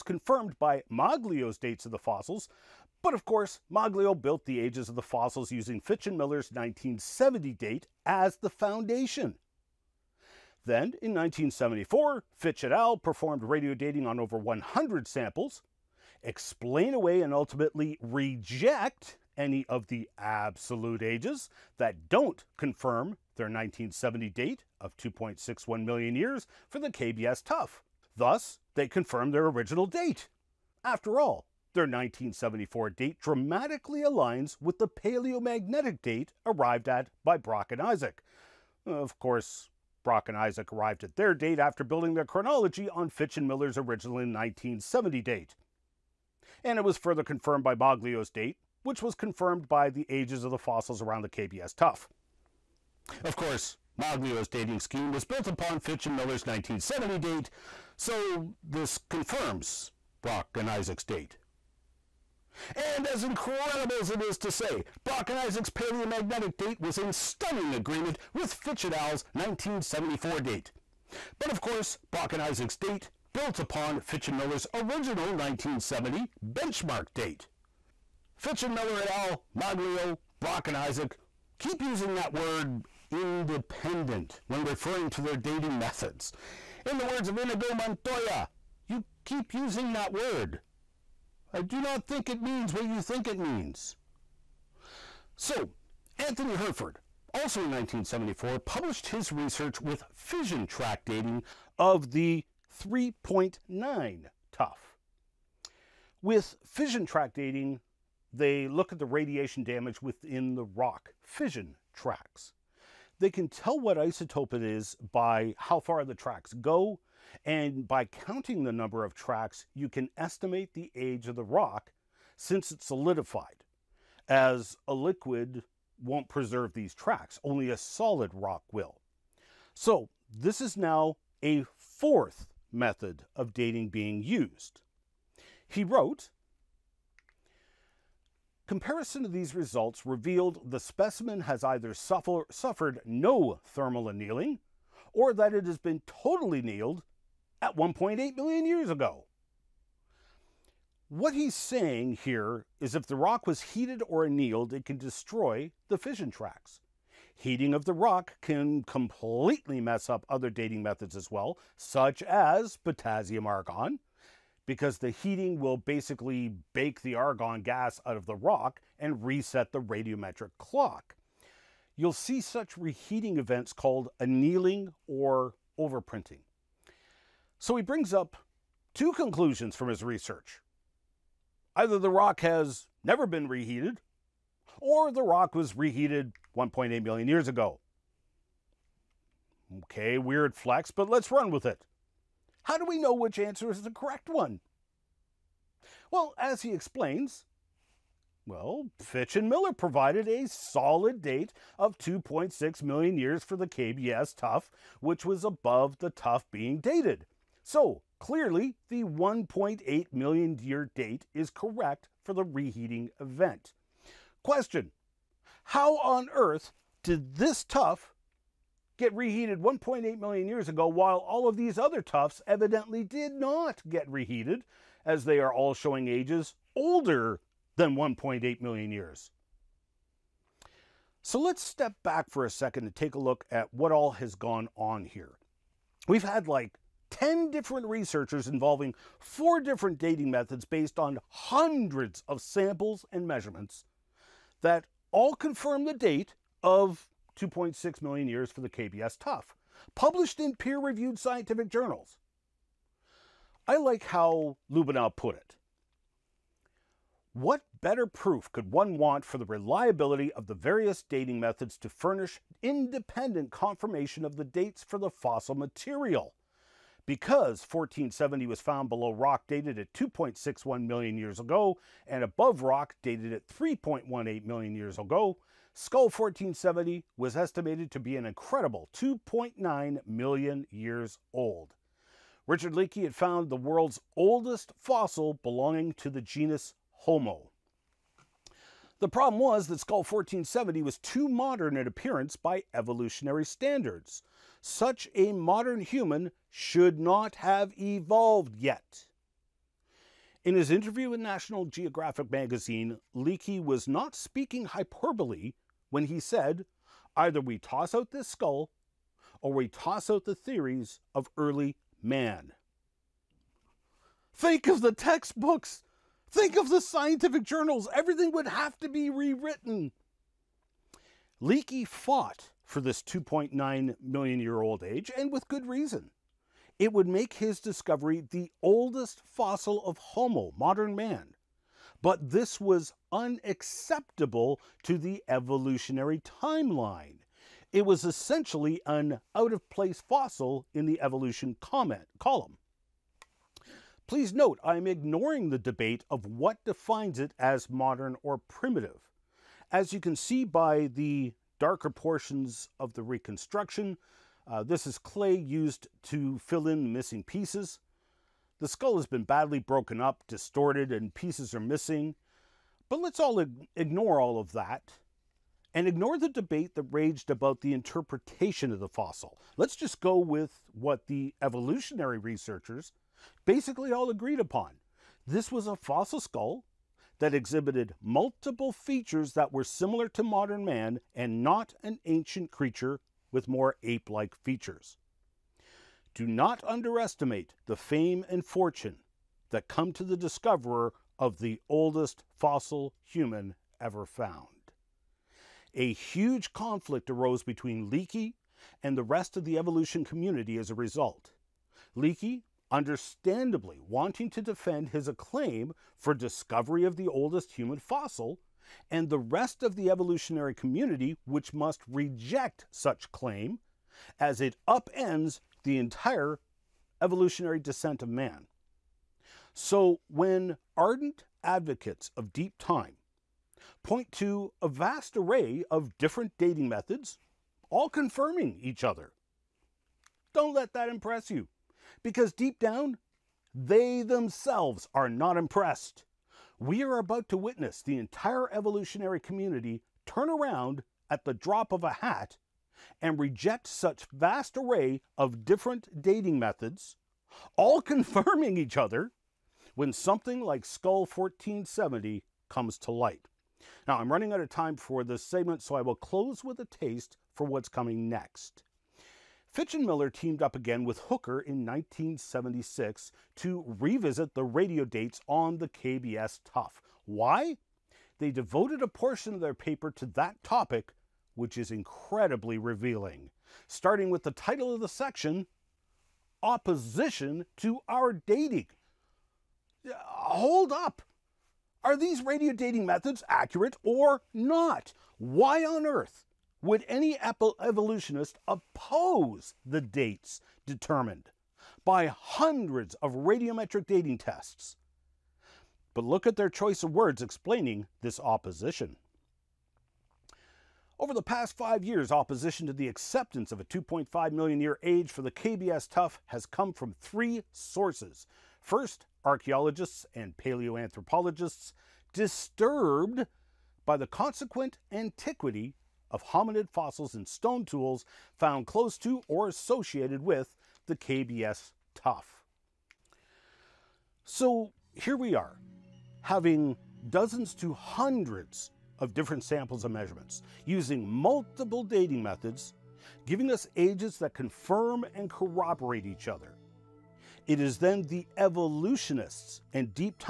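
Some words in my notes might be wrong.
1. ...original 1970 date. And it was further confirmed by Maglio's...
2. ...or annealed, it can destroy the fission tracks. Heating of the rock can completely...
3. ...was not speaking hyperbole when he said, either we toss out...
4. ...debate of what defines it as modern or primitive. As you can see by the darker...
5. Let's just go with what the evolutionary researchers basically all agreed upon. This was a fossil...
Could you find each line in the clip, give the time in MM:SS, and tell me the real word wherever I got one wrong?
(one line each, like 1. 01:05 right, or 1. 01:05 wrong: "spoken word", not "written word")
1. 00:43 right
2. 02:34 right
3. 05:03 right
4. 05:45 right
5. 06:09 right.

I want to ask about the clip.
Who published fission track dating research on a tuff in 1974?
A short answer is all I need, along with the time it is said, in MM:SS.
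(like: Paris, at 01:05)
Anthony Hurford, at 01:36.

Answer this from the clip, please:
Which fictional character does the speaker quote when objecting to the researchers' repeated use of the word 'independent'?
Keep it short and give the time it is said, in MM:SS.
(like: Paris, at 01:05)
Inigo Montoya, at 01:27.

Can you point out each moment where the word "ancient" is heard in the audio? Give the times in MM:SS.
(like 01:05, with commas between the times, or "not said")
06:22.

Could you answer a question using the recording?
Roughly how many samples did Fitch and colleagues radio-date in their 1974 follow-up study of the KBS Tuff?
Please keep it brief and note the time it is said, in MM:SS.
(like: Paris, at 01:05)
over 100, at 00:14.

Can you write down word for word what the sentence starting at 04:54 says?
Such a modern human should not have evolved yet.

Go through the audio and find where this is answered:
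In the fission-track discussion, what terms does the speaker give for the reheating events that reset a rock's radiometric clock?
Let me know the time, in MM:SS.
02:54.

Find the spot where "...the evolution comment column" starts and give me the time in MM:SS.
05:40.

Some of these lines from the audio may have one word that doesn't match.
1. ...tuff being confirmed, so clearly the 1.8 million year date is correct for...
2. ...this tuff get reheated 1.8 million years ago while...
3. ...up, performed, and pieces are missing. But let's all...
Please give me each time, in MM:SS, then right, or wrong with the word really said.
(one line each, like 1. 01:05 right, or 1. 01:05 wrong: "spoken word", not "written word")
1. 03:26 wrong: "dated", not "confirmed"
2. 03:37 right
3. 06:00 wrong: "distorted", not "performed".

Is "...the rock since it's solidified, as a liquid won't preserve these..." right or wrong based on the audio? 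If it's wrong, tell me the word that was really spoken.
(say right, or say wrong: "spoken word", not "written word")
right.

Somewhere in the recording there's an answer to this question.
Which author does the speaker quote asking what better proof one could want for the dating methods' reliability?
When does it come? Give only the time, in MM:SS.
04:14.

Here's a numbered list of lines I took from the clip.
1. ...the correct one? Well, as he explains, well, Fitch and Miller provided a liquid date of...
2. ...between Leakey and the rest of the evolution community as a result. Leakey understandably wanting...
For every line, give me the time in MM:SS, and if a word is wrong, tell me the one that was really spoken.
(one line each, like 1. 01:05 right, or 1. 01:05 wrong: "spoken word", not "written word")
1. 03:13 wrong: "solid", not "liquid"
2. 06:37 right.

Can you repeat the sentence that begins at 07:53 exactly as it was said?
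Starting with the title of the section Opposition to Our Dating.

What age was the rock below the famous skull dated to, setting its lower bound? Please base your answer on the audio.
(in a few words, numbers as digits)
3.18 million years.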